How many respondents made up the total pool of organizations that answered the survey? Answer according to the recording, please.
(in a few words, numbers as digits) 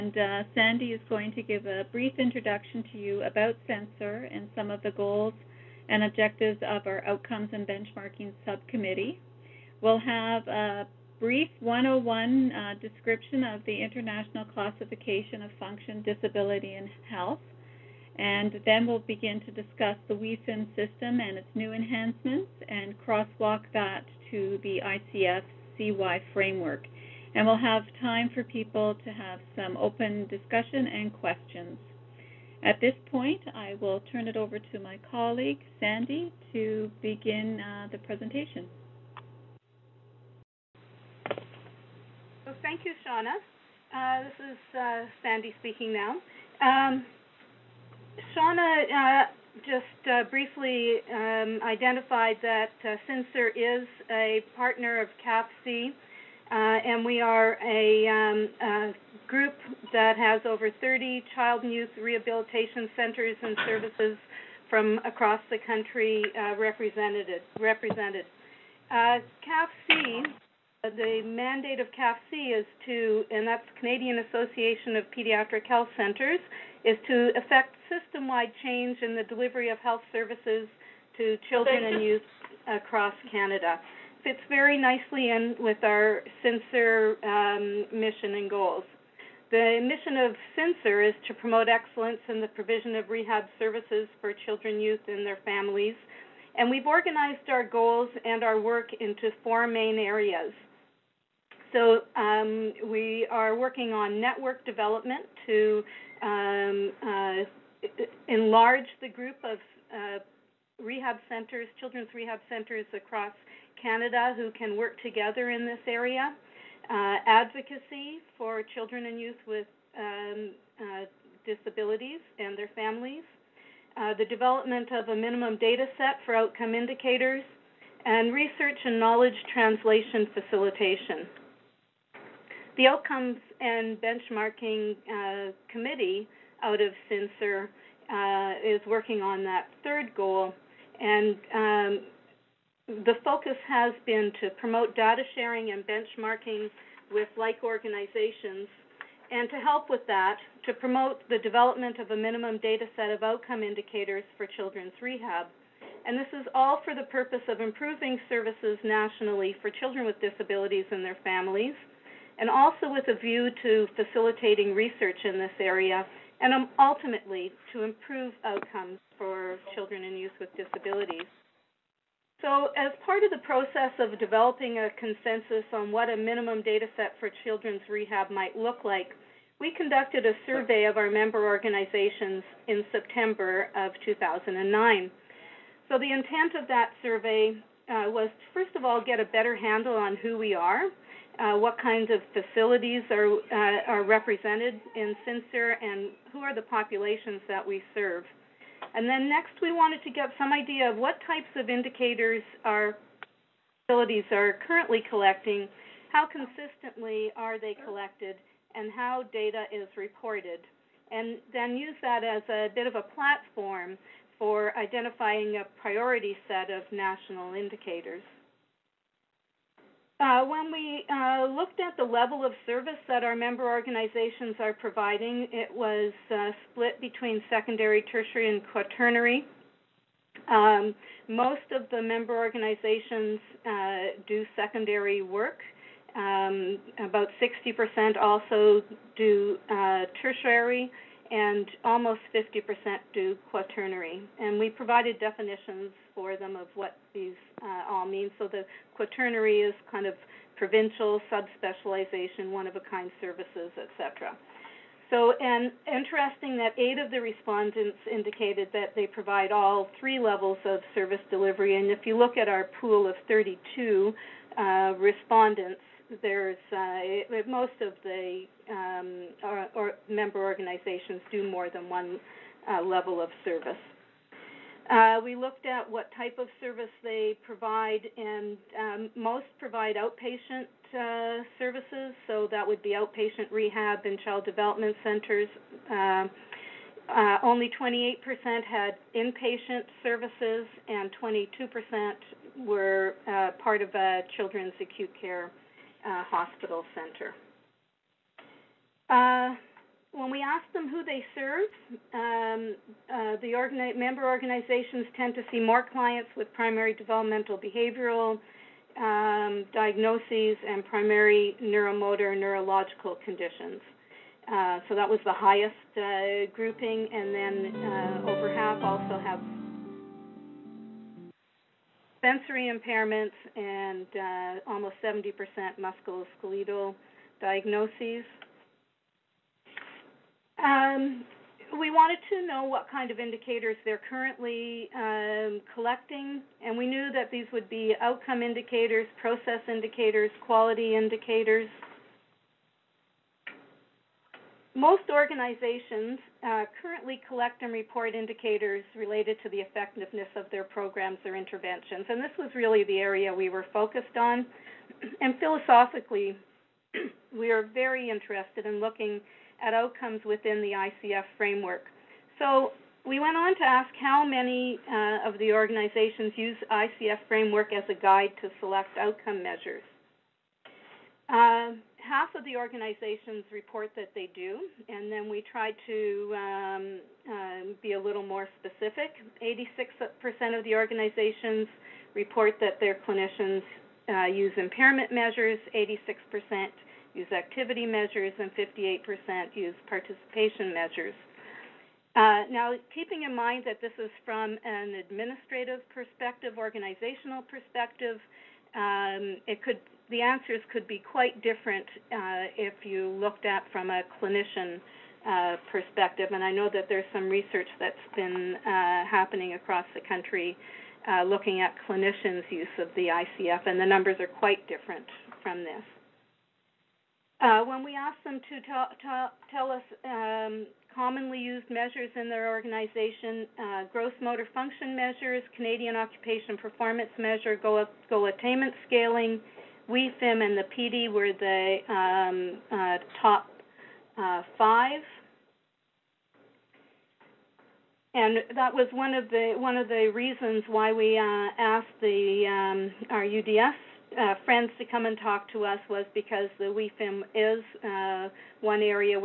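32.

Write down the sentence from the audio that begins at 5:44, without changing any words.
Most organizations uh, currently collect and report indicators related to the effectiveness of their programs or interventions.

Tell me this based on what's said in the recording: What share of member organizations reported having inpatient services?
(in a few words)
28%.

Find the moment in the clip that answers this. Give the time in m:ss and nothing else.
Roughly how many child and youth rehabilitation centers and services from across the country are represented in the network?
1:00.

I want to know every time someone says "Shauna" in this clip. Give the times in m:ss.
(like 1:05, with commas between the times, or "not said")
0:43, 0:48.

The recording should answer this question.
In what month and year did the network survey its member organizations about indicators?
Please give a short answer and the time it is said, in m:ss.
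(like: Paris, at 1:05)
September 2009, at 3:02.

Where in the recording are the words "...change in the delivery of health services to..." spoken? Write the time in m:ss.
1:18.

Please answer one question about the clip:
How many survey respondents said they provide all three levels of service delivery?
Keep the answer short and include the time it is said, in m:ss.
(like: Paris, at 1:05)
8, at 4:16.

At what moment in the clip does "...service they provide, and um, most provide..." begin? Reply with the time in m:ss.
4:36.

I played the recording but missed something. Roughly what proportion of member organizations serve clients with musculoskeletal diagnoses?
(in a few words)
almost 70%.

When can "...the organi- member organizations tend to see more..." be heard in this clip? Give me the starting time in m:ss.
5:03.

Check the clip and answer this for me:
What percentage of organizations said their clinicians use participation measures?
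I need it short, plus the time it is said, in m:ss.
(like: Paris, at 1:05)
58%, at 6:28.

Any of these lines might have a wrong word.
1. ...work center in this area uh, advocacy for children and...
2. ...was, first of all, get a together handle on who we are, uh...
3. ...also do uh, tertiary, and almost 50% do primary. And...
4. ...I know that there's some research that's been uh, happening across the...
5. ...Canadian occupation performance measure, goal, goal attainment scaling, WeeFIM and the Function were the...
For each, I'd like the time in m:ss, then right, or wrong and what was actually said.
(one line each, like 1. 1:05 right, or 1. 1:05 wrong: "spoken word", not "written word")
1. 1:54 wrong: "together", not "center"
2. 3:08 wrong: "better", not "together"
3. 3:58 wrong: "quaternary", not "primary"
4. 6:46 right
5. 7:05 wrong: "PEDI", not "Function".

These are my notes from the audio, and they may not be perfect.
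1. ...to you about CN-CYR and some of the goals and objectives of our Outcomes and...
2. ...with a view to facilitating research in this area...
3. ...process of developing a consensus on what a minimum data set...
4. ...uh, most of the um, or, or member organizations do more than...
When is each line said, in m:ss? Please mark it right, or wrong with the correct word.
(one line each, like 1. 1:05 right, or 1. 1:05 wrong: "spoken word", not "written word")
1. 0:02 right
2. 2:42 right
3. 2:53 right
4. 4:26 right.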